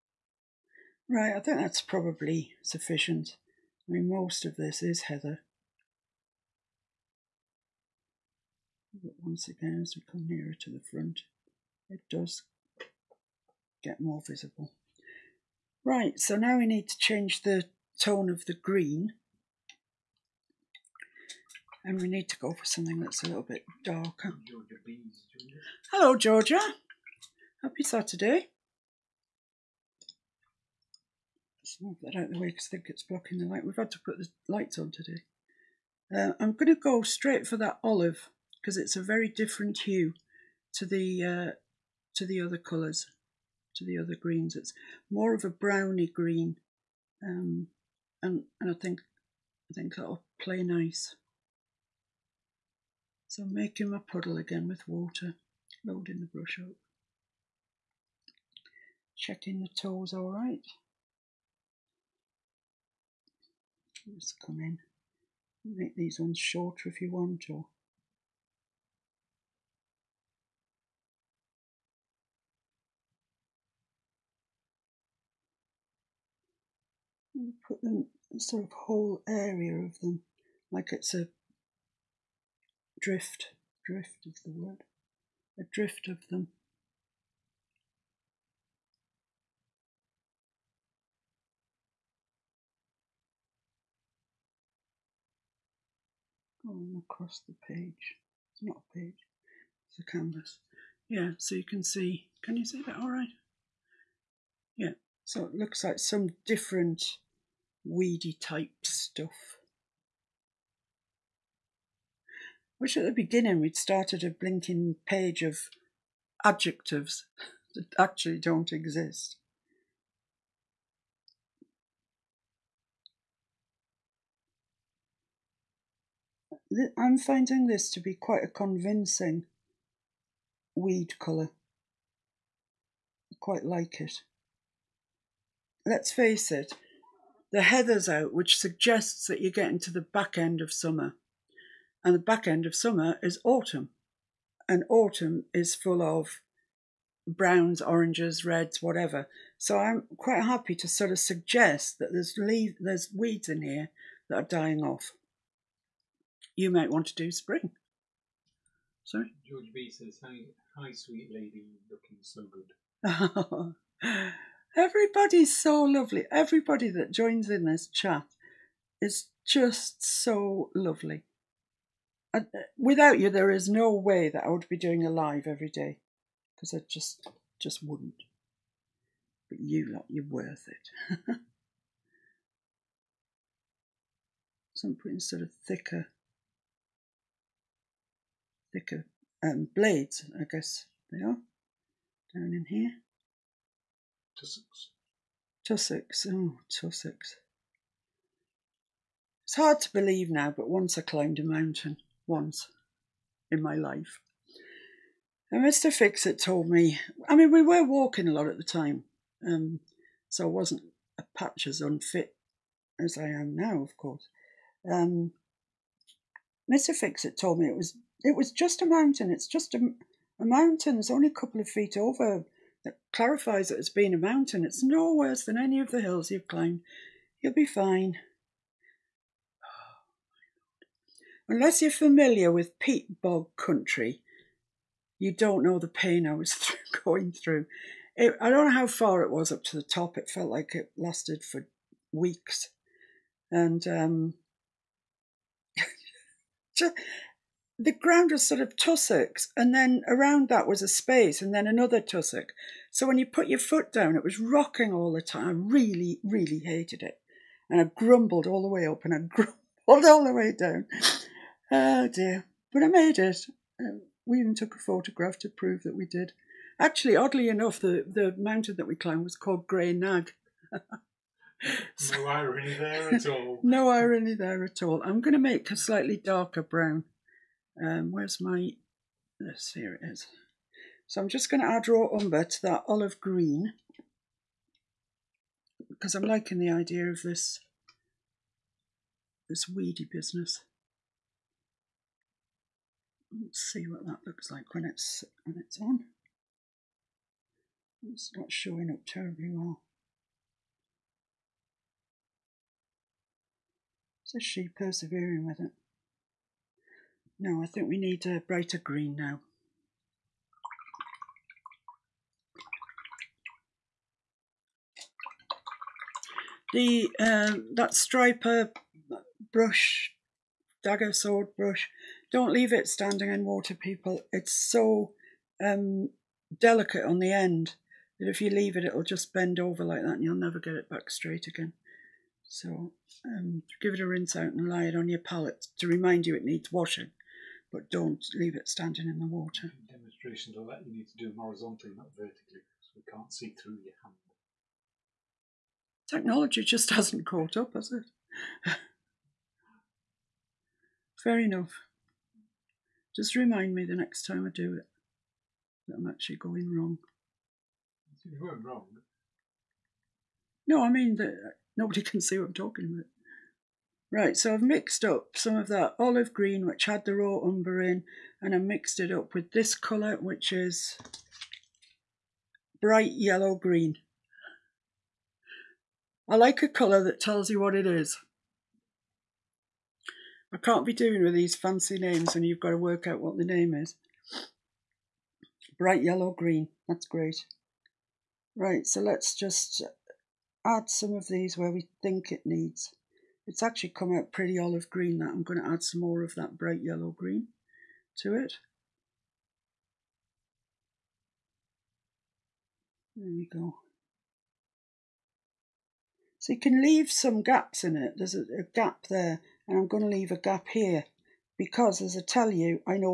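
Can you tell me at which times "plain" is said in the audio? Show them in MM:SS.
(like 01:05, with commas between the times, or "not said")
not said.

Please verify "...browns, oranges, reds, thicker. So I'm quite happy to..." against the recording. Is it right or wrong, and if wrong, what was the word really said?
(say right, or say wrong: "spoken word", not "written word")
wrong: "whatever", not "thicker".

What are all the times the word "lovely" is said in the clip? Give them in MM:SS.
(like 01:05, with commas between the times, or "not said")
02:45, 02:50.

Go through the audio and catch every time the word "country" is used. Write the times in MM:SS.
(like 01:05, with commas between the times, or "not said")
03:53.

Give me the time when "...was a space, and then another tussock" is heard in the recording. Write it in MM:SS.
04:10.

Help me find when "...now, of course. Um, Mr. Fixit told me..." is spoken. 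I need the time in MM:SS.
03:33.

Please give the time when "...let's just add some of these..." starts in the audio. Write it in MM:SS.
06:29.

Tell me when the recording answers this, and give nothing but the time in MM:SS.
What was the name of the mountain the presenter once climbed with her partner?
04:29.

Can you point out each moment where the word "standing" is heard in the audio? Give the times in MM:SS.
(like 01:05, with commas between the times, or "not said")
05:22, 05:38.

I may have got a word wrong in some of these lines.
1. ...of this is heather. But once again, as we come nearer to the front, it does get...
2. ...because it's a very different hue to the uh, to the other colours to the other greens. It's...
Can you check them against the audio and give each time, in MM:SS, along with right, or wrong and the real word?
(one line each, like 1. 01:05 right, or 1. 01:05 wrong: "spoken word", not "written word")
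1. 00:04 right
2. 00:38 right.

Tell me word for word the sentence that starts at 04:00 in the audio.
It felt like it lasted for weeks.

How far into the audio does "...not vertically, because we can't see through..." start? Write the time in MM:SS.
05:41.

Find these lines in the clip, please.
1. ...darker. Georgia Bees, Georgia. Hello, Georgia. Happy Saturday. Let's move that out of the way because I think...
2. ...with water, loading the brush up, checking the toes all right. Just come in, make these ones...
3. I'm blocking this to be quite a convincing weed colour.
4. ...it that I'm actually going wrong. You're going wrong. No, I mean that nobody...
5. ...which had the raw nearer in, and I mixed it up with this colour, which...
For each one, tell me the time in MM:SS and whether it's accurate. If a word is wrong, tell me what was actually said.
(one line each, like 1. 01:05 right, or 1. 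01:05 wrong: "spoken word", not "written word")
1. 00:23 right
2. 00:54 right
3. 02:06 wrong: "finding", not "blocking"
4. 05:54 right
5. 06:06 wrong: "umber", not "nearer".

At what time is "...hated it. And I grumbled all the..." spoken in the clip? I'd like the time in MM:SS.
04:16.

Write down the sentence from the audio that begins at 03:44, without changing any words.
It's no worse than any of the hills you've climbed.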